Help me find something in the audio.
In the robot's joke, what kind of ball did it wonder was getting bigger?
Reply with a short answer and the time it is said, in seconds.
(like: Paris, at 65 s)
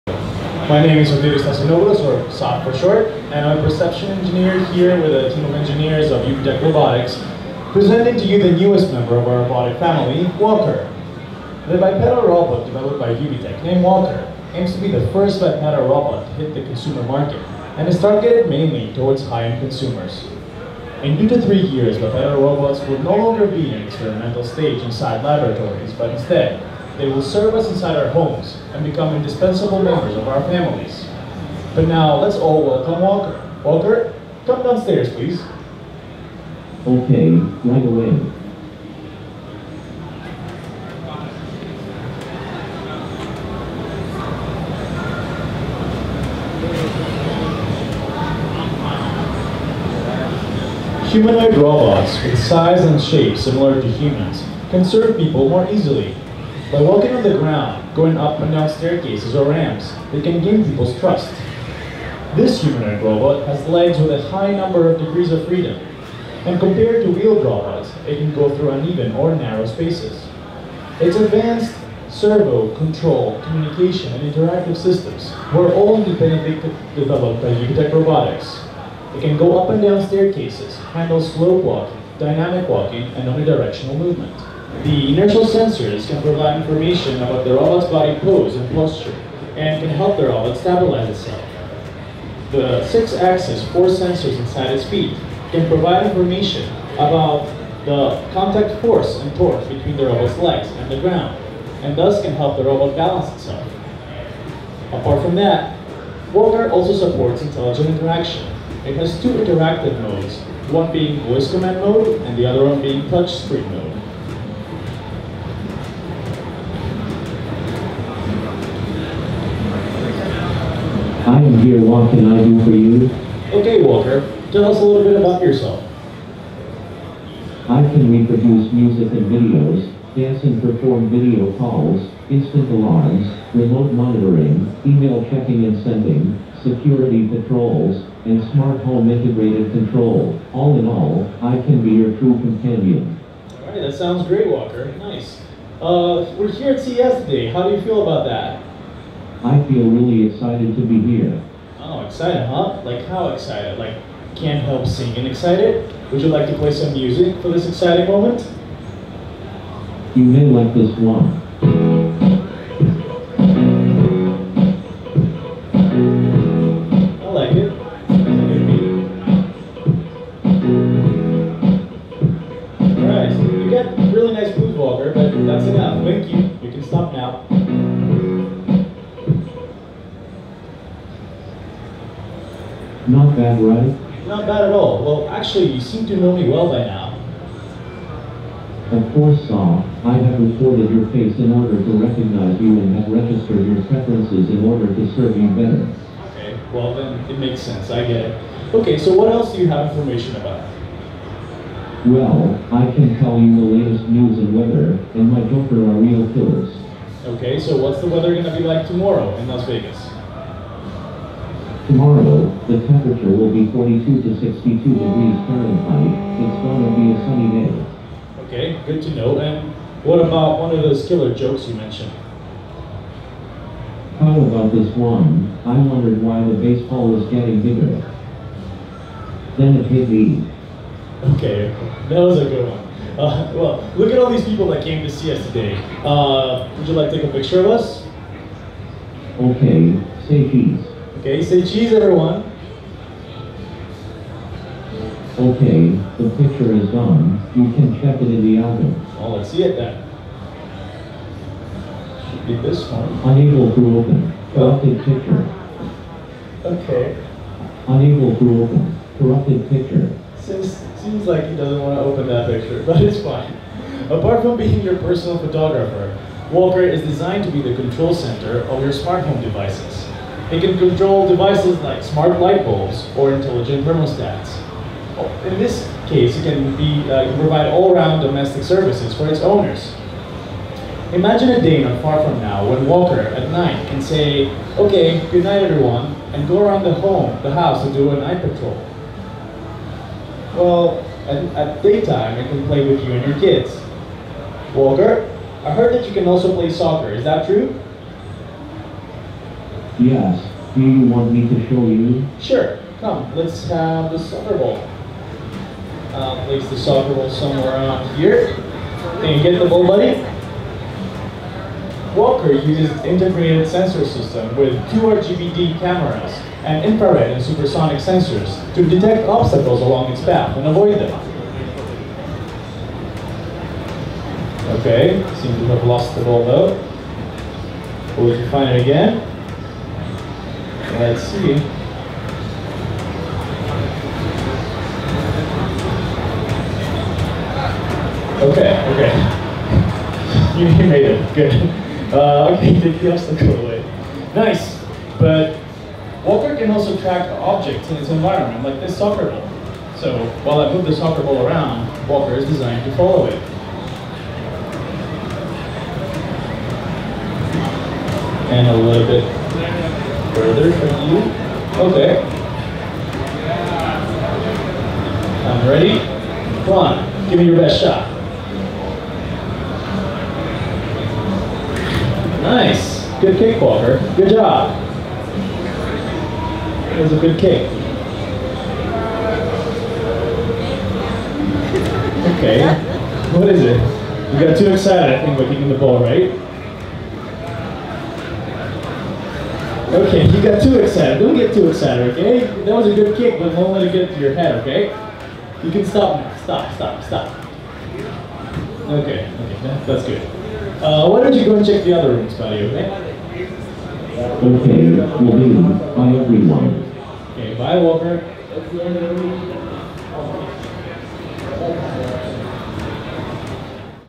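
baseball, at 226 s.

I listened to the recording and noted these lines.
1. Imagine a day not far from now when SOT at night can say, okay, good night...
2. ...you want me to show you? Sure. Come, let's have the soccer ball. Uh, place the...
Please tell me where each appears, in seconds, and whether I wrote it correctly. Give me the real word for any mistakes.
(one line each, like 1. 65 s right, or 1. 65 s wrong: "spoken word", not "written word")
1. 281 s wrong: "Walker", not "SOT"
2. 300 s right.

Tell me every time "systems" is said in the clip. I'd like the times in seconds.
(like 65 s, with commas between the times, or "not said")
74 s, 314 s.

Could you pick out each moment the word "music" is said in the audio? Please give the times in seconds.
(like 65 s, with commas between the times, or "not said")
128 s, 156 s.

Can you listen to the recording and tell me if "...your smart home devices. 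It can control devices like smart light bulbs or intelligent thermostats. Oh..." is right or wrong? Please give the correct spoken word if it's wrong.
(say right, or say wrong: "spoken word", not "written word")
right.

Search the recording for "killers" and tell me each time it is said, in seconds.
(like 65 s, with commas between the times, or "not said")
206 s, 221 s.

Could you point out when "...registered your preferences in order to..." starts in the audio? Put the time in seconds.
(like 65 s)
193 s.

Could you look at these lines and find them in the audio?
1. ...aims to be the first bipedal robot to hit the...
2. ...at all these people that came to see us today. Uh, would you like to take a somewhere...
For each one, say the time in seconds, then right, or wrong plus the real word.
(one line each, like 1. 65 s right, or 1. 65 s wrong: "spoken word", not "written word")
1. 14 s right
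2. 234 s wrong: "picture", not "somewhere".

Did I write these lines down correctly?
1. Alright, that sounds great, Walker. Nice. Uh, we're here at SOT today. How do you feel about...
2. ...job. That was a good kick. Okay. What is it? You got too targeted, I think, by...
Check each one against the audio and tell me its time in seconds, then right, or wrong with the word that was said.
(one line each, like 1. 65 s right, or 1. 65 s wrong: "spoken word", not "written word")
1. 143 s wrong: "CES", not "SOT"
2. 374 s wrong: "excited", not "targeted".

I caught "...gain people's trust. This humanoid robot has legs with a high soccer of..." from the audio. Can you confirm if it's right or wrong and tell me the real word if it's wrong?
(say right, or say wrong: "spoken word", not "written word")
wrong: "number", not "soccer".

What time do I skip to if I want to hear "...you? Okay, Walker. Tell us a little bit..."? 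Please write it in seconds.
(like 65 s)
122 s.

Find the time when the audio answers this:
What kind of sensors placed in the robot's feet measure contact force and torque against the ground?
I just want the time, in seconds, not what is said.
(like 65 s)
92 s.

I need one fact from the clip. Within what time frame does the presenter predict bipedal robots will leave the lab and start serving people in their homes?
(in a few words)
2 to 3 years.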